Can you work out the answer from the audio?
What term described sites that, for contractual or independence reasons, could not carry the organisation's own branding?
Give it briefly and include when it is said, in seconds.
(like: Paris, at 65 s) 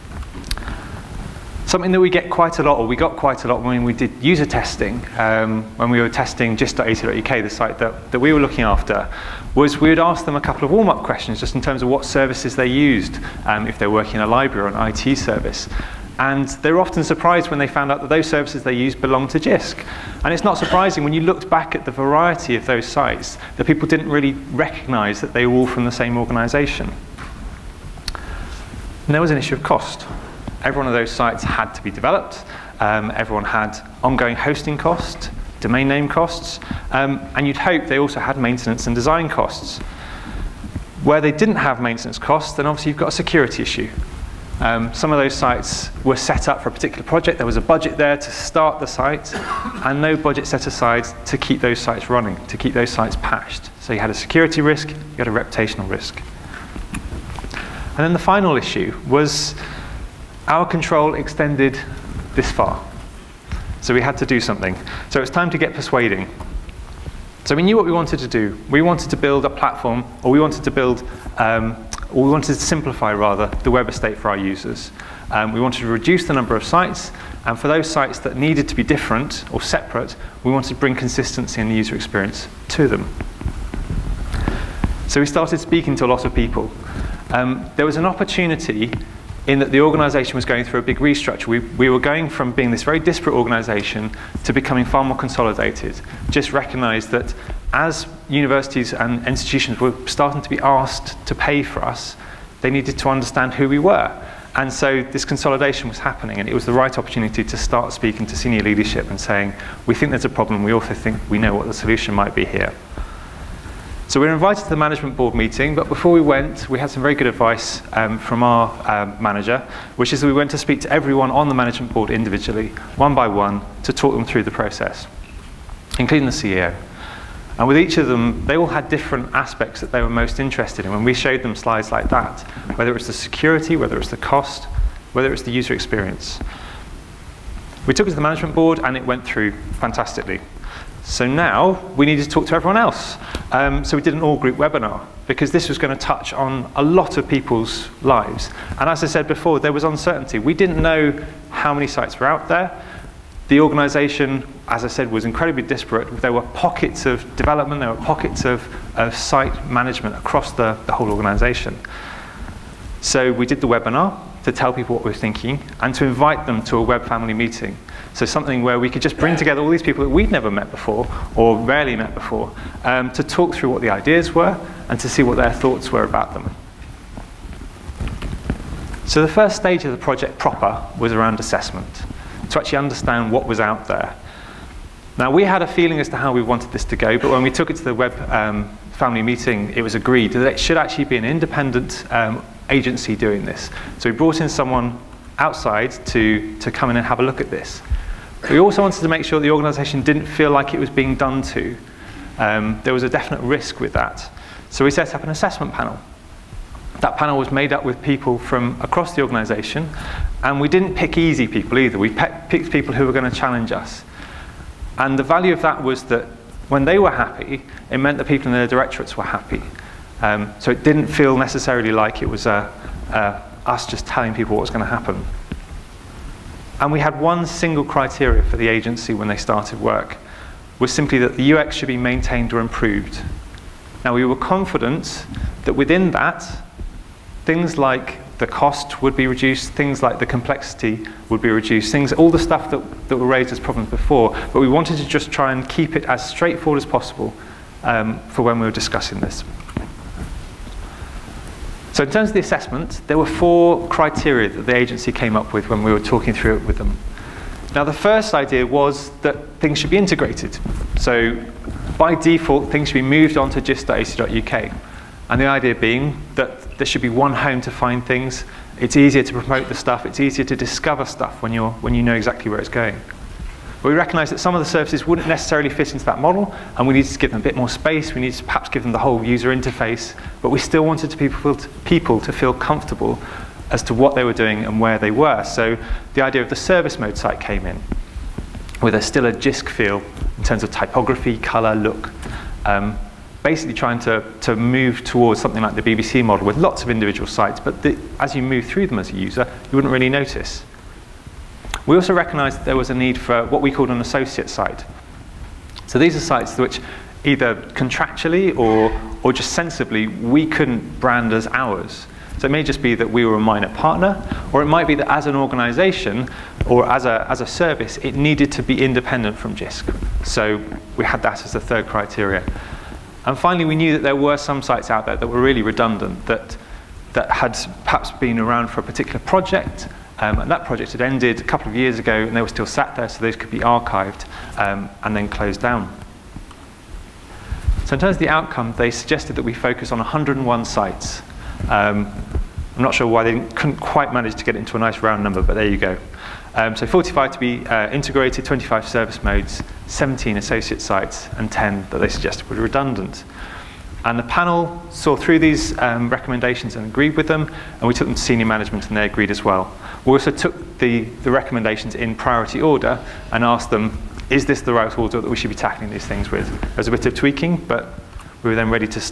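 associate site, at 304 s.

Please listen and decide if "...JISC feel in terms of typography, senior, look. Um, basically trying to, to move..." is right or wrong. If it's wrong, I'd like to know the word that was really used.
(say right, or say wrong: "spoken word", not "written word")
wrong: "color", not "senior".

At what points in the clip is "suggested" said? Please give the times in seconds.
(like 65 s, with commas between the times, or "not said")
338 s, 352 s.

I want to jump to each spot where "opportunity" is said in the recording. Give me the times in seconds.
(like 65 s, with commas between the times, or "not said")
88 s, 106 s.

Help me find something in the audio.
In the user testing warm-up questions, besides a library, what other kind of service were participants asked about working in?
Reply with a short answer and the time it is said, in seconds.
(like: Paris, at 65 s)
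IT service, at 14 s.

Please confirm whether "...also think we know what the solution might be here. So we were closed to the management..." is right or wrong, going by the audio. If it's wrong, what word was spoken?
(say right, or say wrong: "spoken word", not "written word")
wrong: "invited", not "closed".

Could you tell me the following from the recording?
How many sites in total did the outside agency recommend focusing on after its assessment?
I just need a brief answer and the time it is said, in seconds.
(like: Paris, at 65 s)
101, at 339 s.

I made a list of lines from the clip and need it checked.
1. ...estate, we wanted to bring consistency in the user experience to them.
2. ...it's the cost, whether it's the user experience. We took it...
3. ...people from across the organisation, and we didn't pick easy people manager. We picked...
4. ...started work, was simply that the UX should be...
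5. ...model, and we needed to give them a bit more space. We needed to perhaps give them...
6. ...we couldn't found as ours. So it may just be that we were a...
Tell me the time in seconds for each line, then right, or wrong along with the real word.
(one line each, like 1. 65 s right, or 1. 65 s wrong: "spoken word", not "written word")
1. 79 s wrong: "separate", not "estate"
2. 133 s right
3. 208 s wrong: "either", not "manager"
4. 229 s right
5. 276 s right
6. 310 s wrong: "brand", not "found".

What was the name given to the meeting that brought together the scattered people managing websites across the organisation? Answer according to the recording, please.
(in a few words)
web family meeting.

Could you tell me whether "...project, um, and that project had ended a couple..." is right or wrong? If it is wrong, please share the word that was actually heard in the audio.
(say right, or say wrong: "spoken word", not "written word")
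right.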